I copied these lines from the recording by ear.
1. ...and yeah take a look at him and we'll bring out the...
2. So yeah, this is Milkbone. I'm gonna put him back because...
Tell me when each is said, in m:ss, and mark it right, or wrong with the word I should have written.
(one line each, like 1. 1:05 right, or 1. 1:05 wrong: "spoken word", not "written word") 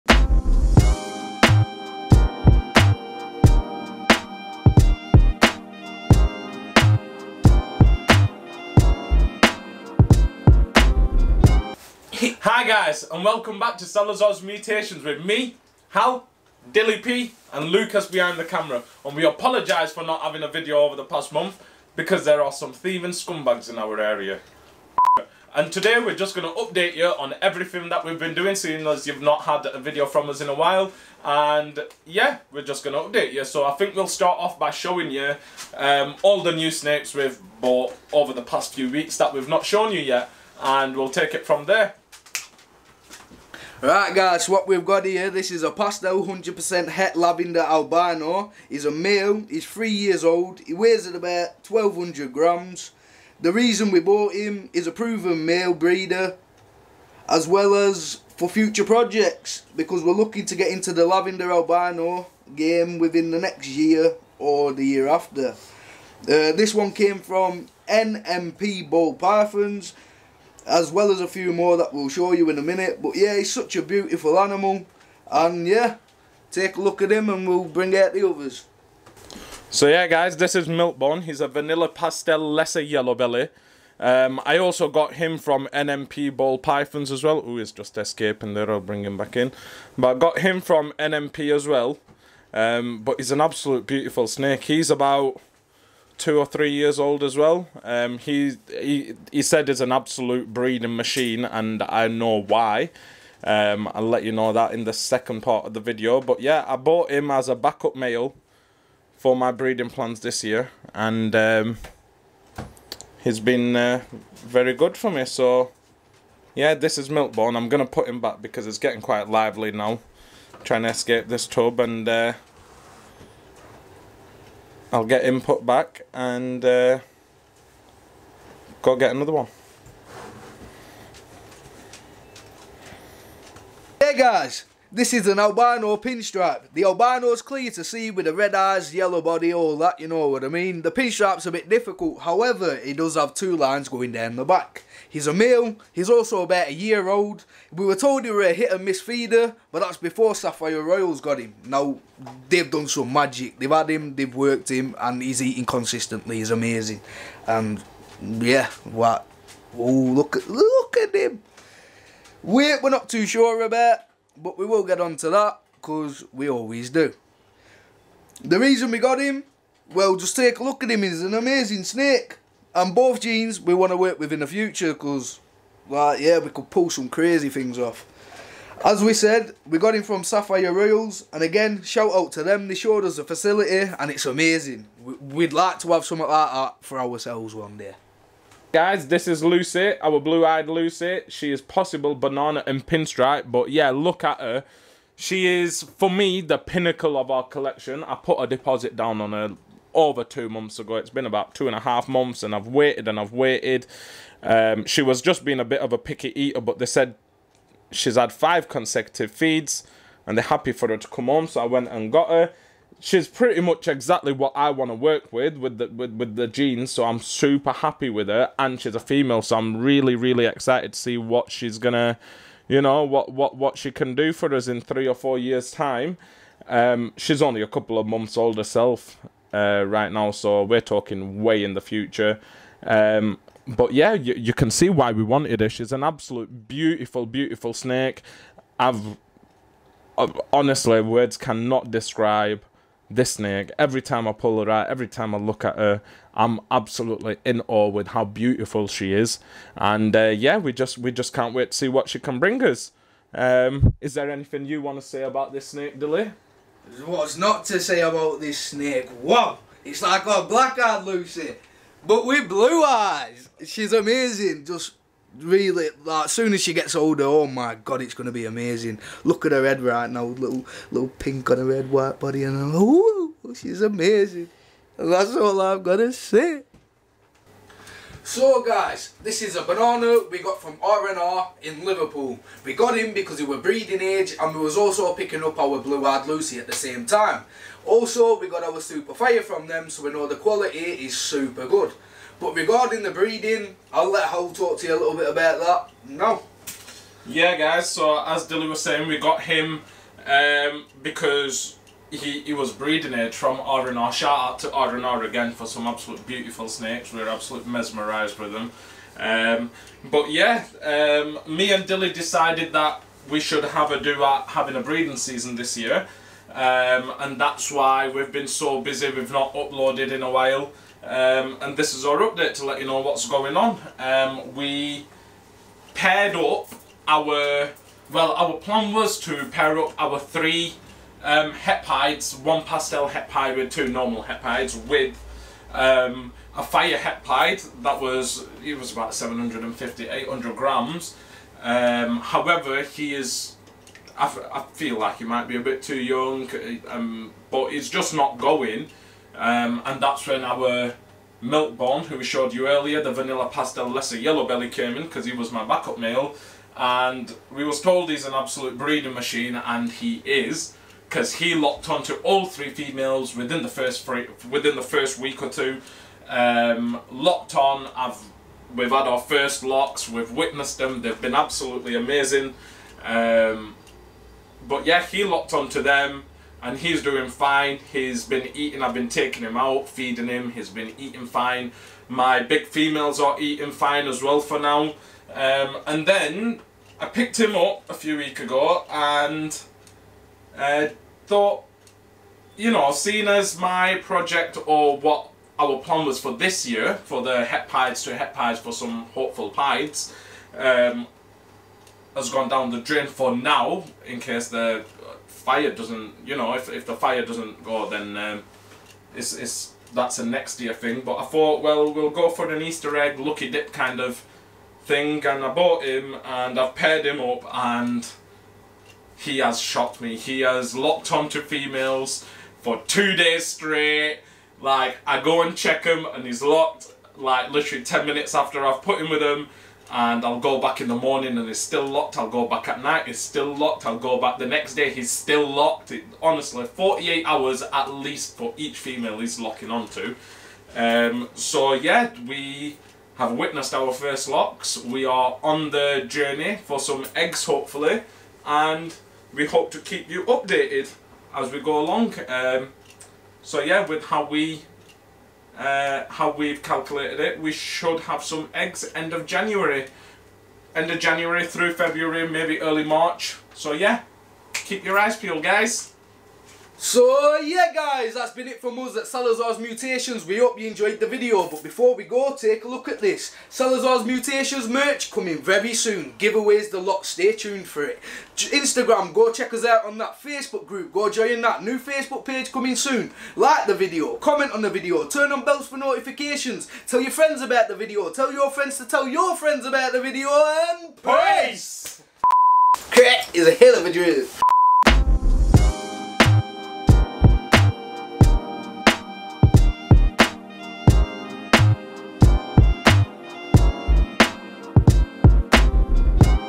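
1. 1:15 right
2. 1:55 right.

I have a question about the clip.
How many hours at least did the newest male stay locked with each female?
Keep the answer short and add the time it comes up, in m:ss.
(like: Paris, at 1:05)
48, at 7:16.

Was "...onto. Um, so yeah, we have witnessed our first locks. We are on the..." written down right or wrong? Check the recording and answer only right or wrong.
right.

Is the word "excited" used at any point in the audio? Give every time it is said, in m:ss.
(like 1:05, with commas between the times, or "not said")
3:40.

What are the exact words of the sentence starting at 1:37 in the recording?
Um, he he he said is an absolute breeding machine, and I know why.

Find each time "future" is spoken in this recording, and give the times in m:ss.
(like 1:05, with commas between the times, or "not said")
0:58, 2:54, 3:51.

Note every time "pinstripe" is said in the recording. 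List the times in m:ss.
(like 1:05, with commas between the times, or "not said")
2:15, 2:20, 3:12.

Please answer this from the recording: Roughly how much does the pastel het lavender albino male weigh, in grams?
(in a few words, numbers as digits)
1200 grams.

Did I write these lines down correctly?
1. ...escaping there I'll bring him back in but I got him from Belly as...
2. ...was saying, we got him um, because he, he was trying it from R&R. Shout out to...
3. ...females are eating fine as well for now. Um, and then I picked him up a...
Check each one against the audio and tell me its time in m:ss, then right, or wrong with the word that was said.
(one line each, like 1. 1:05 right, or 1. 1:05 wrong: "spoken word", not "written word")
1. 1:27 wrong: "NMP", not "Belly"
2. 4:58 wrong: "breeding", not "trying"
3. 6:22 right.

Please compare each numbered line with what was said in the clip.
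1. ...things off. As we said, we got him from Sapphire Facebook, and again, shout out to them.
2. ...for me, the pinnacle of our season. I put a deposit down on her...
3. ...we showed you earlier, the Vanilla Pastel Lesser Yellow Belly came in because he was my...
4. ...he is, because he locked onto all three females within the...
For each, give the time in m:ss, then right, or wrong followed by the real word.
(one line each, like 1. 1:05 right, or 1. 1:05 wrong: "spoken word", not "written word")
1. 2:57 wrong: "Royals", not "Facebook"
2. 3:15 wrong: "collection", not "season"
3. 5:52 right
4. 5:59 right.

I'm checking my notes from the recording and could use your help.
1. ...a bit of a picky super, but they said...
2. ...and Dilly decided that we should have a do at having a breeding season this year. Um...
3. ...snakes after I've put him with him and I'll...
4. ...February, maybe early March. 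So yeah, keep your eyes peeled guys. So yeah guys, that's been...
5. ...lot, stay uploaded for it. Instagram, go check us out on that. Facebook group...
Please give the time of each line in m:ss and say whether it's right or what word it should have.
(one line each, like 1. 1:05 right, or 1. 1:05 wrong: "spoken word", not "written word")
1. 3:25 wrong: "eater", not "super"
2. 5:11 right
3. 7:08 wrong: "minutes", not "snakes"
4. 7:41 right
5. 7:56 wrong: "tuned", not "uploaded".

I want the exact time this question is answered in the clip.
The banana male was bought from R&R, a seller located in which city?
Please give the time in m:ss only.
4:41.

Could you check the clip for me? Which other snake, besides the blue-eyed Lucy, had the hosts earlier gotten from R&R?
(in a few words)
super fire.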